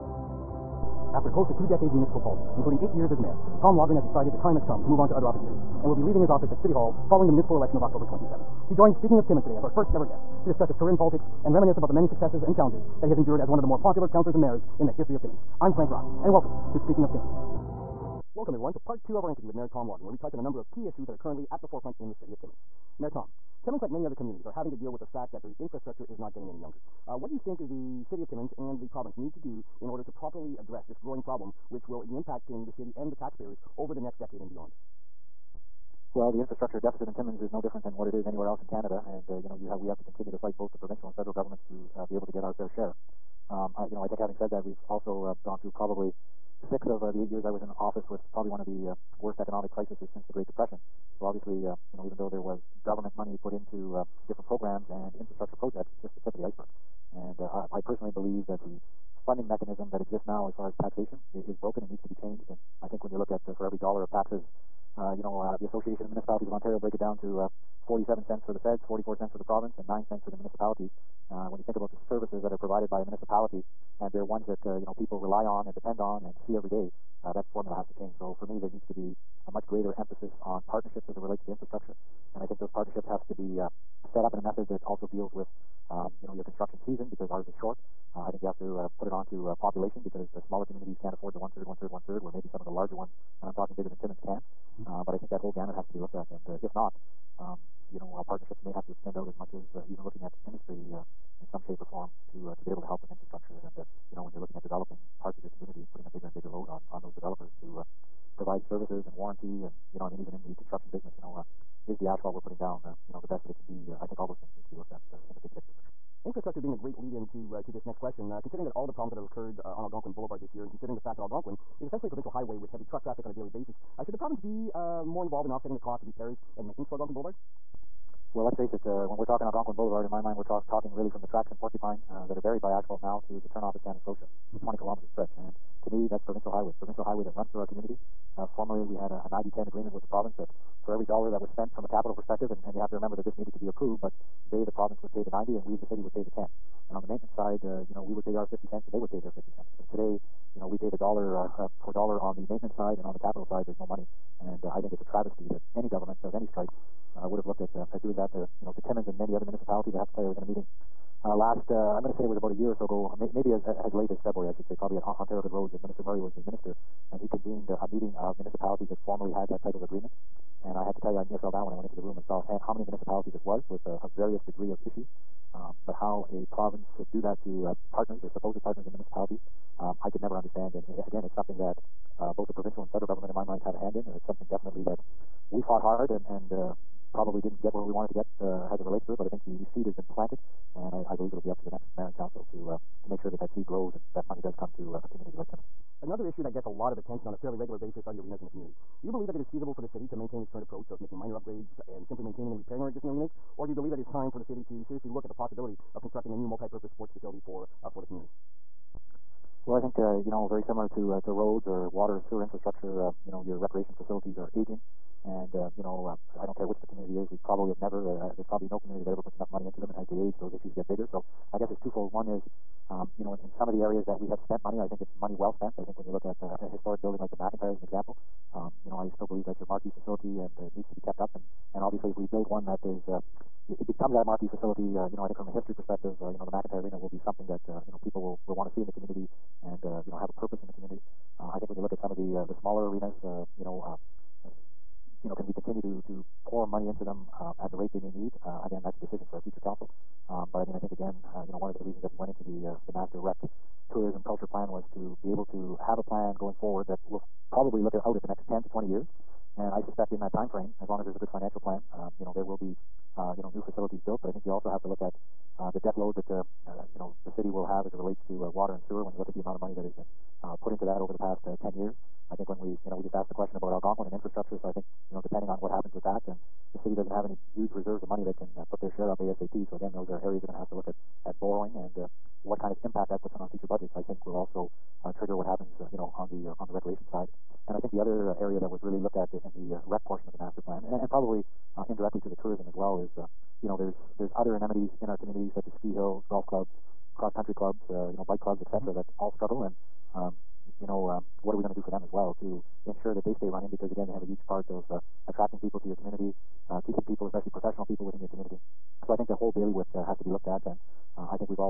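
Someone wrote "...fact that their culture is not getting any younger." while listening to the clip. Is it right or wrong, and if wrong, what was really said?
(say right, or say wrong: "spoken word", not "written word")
wrong: "infrastructure", not "culture".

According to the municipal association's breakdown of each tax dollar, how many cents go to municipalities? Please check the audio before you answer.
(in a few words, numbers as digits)
9 cents.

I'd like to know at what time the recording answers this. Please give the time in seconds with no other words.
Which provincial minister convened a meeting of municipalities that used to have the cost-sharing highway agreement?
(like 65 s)
165 s.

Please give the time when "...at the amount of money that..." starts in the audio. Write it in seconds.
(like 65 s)
269 s.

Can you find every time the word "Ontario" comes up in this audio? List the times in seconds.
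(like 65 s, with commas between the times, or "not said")
66 s, 165 s.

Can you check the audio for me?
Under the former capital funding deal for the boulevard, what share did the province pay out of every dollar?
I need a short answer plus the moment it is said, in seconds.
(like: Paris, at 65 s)
90 cents, at 144 s.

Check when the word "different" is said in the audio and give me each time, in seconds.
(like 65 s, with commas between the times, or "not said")
37 s, 54 s.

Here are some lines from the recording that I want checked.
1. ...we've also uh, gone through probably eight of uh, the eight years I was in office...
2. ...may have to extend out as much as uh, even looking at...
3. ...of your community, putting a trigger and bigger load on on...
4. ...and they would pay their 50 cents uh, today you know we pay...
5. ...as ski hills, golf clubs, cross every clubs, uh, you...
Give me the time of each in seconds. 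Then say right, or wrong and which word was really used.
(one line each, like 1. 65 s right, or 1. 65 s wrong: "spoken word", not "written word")
1. 44 s wrong: "six", not "eight"
2. 98 s right
3. 105 s wrong: "bigger", not "trigger"
4. 148 s right
5. 295 s wrong: "country", not "every".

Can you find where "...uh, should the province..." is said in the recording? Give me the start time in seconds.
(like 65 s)
123 s.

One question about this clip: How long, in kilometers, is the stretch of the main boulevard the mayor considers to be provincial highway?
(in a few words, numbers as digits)
20 kilometers.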